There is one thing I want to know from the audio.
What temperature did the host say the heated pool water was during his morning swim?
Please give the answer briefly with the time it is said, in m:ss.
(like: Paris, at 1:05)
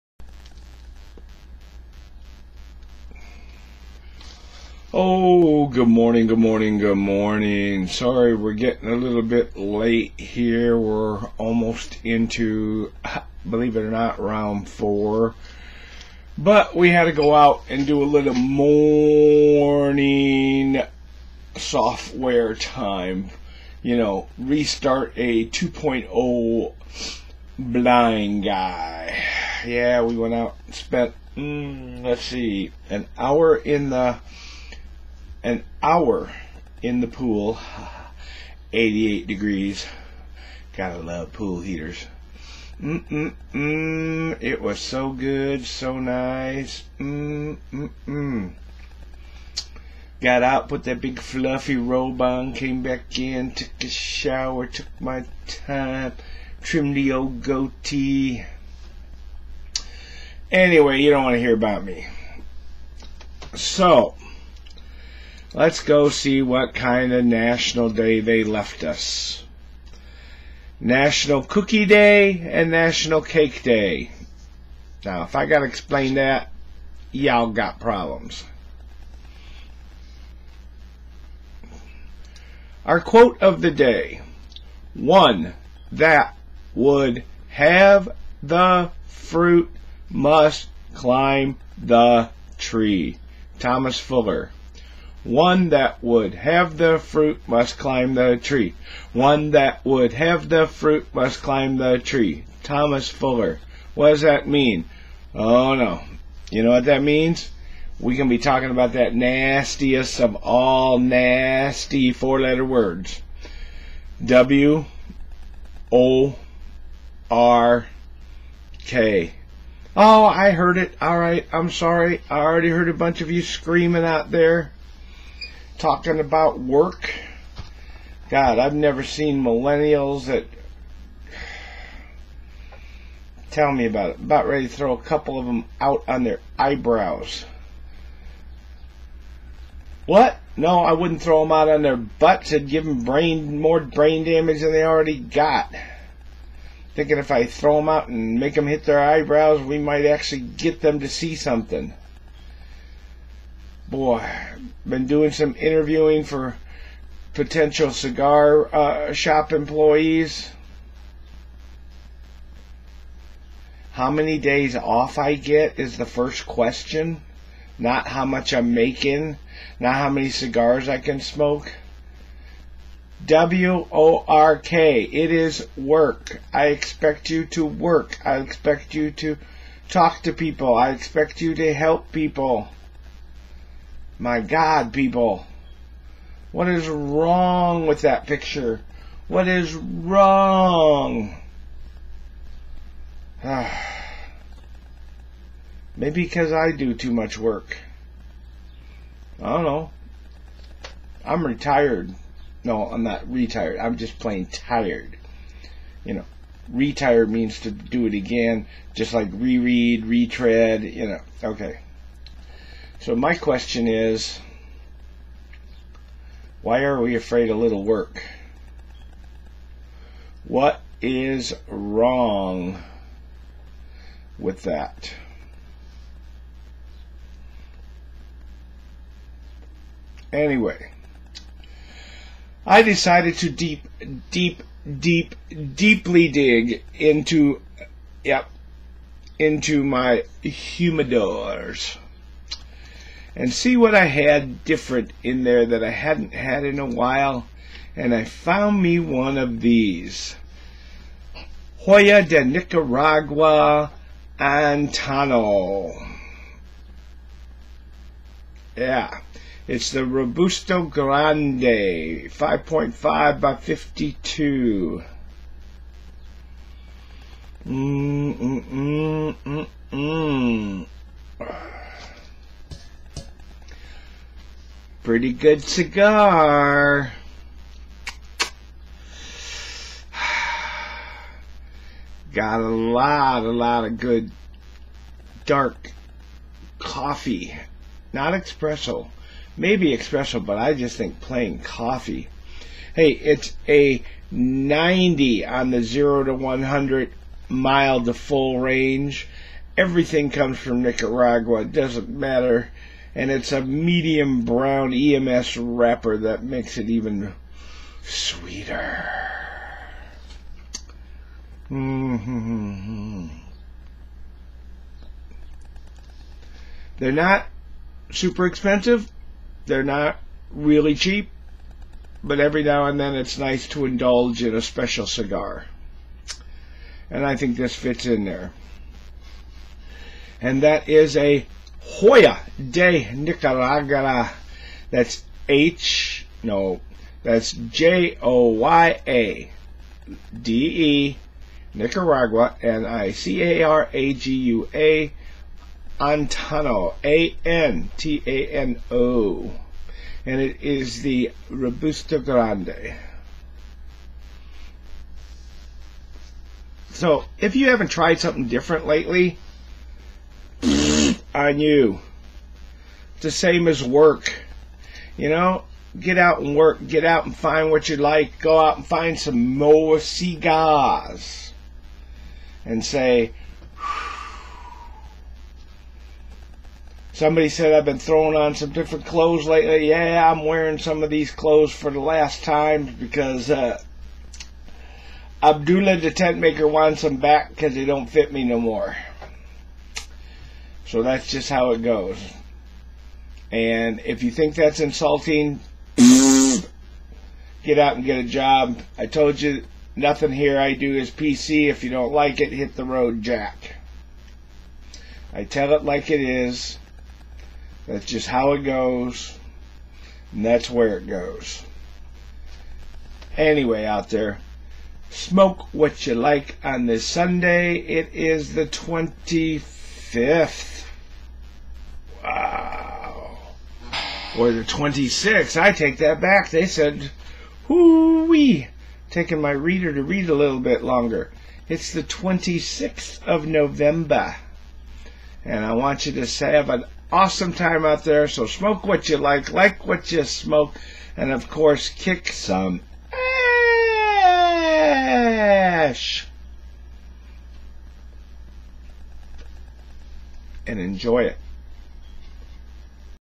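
88 degrees, at 0:38.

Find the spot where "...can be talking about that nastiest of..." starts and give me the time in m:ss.
1:48.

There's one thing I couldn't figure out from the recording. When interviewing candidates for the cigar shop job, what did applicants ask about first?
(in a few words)
How many days off.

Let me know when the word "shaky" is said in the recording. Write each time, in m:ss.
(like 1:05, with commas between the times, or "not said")
not said.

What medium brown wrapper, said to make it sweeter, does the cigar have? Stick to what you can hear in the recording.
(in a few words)
EMS.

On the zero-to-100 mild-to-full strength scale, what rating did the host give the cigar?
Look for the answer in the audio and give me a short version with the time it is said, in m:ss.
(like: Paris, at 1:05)
90, at 4:54.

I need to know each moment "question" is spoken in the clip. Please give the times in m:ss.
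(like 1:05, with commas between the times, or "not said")
2:46, 3:33.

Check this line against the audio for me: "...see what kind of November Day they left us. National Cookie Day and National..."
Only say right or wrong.
wrong.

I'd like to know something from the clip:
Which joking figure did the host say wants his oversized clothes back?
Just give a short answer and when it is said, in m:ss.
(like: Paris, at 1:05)
Abdullah the tent maker, at 6:25.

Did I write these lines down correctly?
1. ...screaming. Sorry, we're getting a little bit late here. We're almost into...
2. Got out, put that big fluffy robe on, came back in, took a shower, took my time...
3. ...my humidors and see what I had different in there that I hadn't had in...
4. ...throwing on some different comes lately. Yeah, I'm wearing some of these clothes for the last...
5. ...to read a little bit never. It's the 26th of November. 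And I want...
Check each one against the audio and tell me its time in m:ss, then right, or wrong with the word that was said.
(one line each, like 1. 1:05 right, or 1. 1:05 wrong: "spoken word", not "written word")
1. 0:06 wrong: "morning", not "screaming"
2. 0:50 right
3. 3:59 right
4. 6:17 wrong: "clothes", not "comes"
5. 7:09 wrong: "longer", not "never".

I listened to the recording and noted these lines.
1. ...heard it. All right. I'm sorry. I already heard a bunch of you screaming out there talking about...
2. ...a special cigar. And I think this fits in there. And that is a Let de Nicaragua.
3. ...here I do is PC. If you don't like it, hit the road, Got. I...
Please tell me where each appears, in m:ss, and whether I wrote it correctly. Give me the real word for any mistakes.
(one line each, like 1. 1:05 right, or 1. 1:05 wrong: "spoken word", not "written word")
1. 2:00 right
2. 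5:24 wrong: "Joya", not "Let"
3. 6:40 wrong: "Jack", not "Got".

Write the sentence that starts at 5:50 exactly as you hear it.
And it is the Robusto Grande.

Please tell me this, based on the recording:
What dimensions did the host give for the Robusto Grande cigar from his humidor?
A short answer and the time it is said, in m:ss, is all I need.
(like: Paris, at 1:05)
5.5 by 52, at 4:21.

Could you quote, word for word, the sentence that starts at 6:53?
Anyway, out there, smoke what you like on this Sunday.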